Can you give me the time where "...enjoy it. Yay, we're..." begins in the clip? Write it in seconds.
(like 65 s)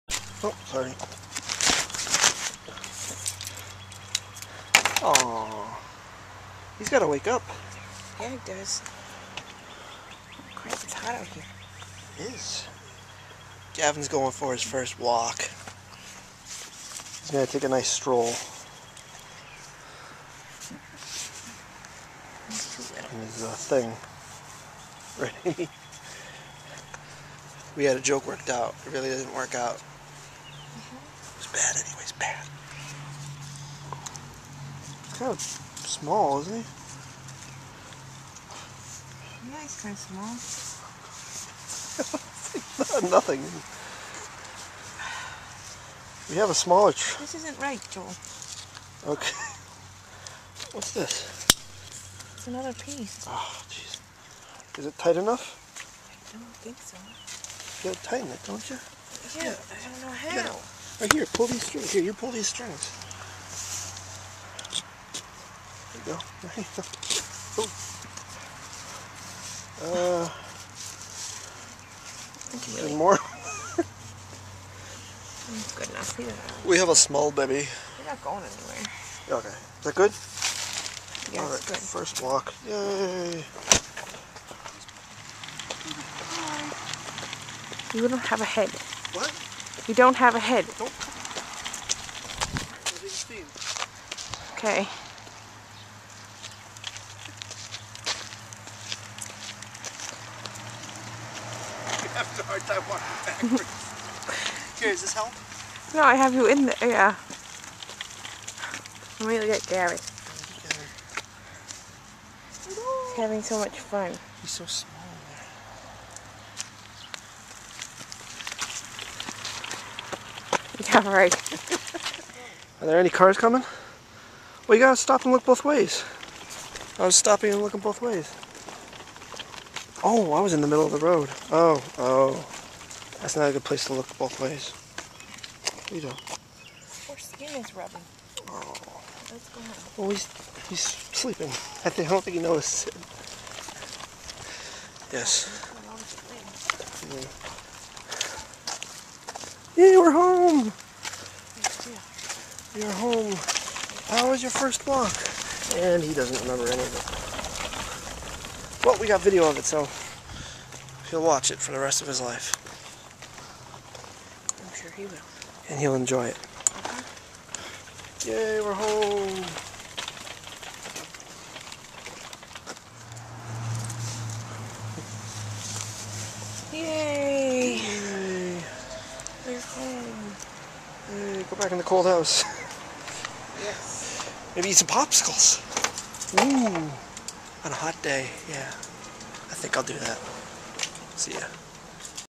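165 s.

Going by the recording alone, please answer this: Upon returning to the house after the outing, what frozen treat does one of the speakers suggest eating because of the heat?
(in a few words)
Popsicles.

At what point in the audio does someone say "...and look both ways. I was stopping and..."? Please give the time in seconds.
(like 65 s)
125 s.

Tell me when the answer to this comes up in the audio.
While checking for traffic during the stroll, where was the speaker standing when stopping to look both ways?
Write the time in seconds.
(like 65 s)
130 s.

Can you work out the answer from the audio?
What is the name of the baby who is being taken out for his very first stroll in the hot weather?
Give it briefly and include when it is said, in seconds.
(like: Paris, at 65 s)
Gavin, at 13 s.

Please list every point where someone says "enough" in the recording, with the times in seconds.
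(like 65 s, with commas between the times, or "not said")
55 s, 75 s.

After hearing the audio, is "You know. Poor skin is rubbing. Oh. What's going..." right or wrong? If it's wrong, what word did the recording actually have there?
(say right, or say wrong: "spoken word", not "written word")
right.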